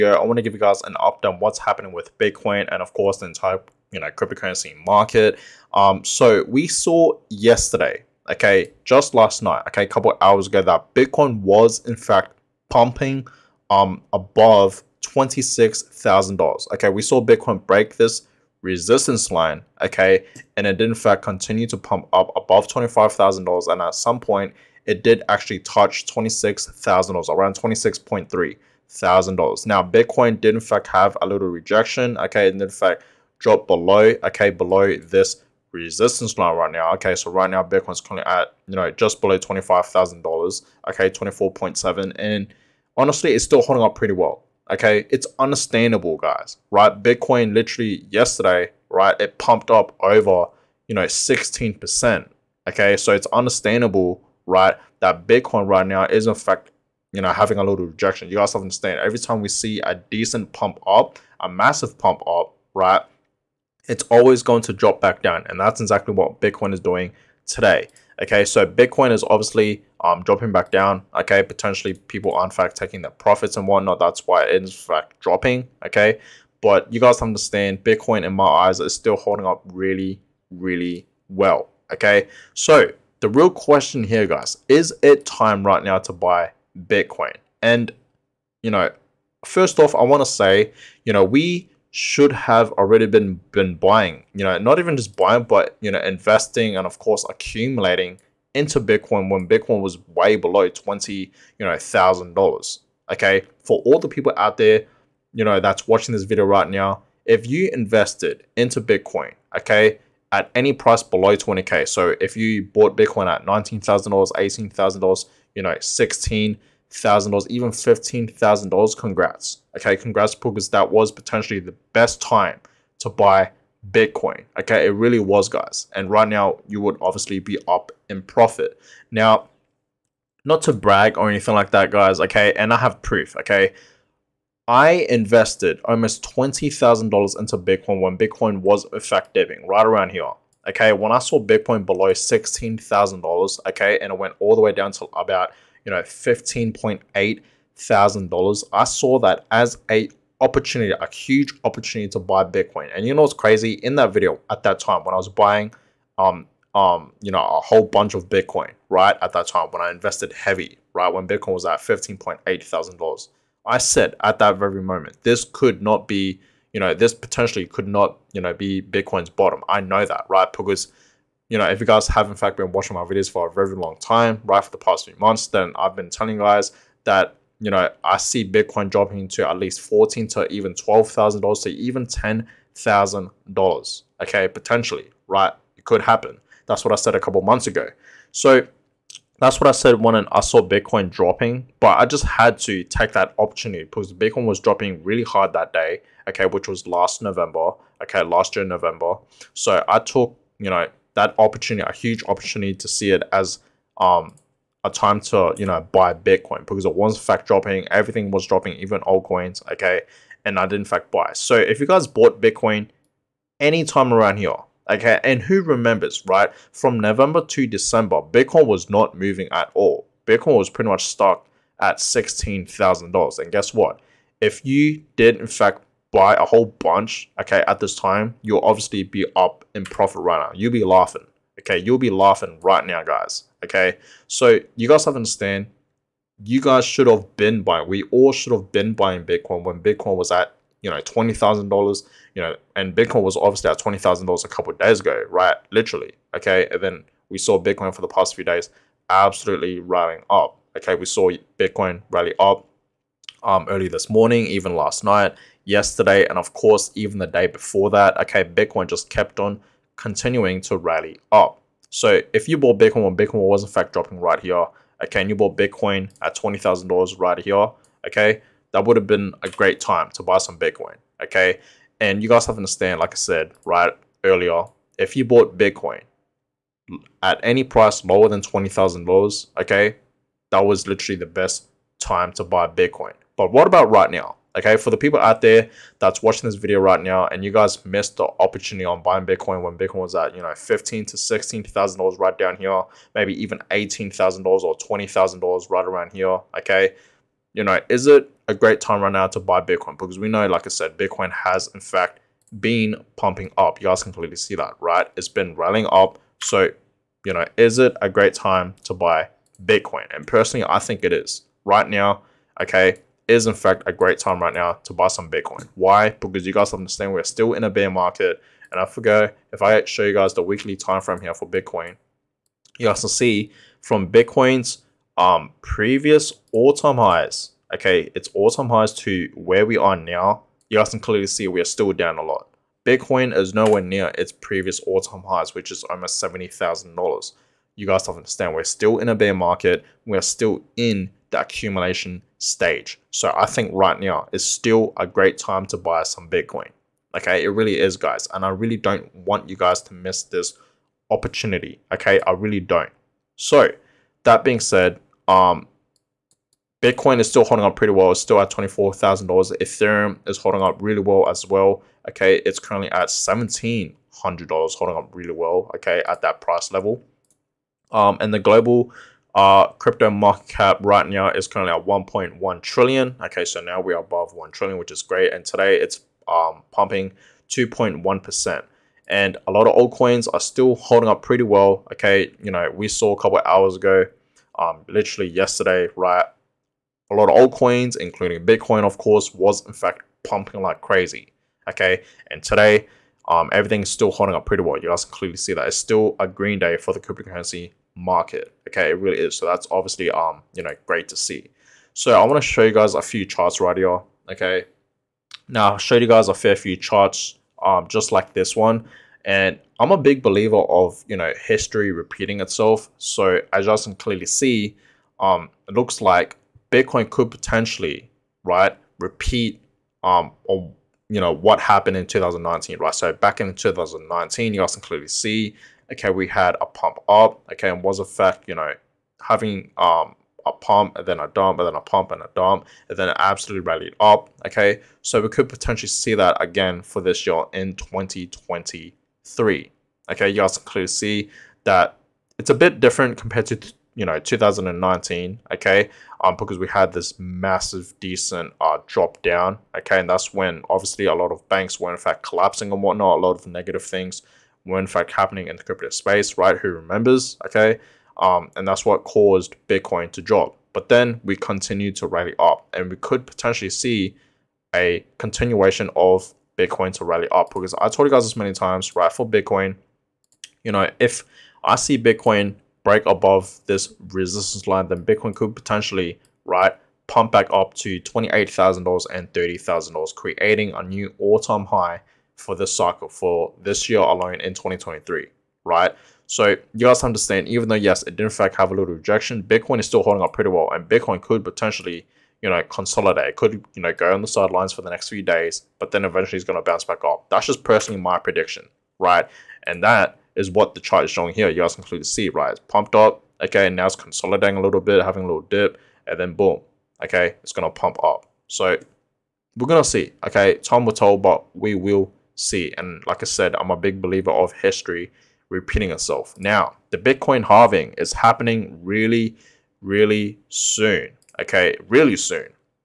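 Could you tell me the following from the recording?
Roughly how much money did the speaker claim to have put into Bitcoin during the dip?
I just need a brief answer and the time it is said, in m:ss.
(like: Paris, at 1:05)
$20,000, at 2:15.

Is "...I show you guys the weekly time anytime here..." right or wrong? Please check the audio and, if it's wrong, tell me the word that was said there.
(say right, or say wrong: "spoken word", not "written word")
wrong: "frame", not "anytime".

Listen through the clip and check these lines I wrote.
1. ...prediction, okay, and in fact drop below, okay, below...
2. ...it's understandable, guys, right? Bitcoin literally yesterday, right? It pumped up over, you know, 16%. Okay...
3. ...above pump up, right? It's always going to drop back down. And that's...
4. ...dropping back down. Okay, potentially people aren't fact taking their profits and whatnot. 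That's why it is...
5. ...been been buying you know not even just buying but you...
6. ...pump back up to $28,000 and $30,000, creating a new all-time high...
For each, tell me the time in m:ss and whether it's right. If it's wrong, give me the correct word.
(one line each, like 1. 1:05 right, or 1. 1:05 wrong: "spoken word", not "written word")
1. 0:31 wrong: "rejection", not "prediction"
2. 0:45 right
3. 1:01 wrong: "massive", not "above"
4. 1:10 right
5. 1:33 right
6. 7:57 right.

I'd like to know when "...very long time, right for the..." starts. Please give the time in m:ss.
2:53.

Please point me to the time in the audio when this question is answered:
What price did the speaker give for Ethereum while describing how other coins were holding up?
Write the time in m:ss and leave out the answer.
6:03.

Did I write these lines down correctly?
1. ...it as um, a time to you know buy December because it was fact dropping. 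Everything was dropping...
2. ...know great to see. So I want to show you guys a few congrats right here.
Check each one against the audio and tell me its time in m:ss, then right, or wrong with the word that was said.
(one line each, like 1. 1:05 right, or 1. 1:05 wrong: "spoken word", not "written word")
1. 3:23 wrong: "Bitcoin", not "December"
2. 6:40 wrong: "charts", not "congrats".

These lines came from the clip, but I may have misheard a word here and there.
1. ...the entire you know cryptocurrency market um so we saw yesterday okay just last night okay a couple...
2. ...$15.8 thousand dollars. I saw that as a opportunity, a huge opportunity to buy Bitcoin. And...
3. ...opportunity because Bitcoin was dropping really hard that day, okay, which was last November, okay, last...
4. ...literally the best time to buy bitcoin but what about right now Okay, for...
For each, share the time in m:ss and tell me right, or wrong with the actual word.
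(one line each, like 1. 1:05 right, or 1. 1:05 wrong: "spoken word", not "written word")
1. 0:03 right
2. 2:26 right
3. 3:13 right
4. 4:40 right.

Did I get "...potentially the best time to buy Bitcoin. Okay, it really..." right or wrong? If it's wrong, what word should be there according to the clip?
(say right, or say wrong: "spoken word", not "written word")
right.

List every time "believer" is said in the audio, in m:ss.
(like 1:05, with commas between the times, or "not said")
6:50, 8:34.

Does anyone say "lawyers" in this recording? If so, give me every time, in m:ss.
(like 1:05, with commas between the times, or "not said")
not said.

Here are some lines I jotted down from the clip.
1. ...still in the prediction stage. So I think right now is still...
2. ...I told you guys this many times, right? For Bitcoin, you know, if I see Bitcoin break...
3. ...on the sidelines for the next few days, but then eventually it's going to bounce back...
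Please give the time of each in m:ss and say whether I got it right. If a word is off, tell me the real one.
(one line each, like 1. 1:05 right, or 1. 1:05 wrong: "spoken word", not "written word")
1. 5:40 wrong: "accumulation", not "prediction"
2. 7:47 right
3. 8:14 right.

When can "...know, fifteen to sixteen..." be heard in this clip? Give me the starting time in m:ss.
4:50.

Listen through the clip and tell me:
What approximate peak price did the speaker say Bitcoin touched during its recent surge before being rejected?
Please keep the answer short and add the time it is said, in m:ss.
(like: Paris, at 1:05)
$26,300, at 0:27.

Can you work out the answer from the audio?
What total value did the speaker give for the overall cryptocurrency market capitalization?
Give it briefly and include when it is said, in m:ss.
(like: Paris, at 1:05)
1.1 trillion, at 6:11.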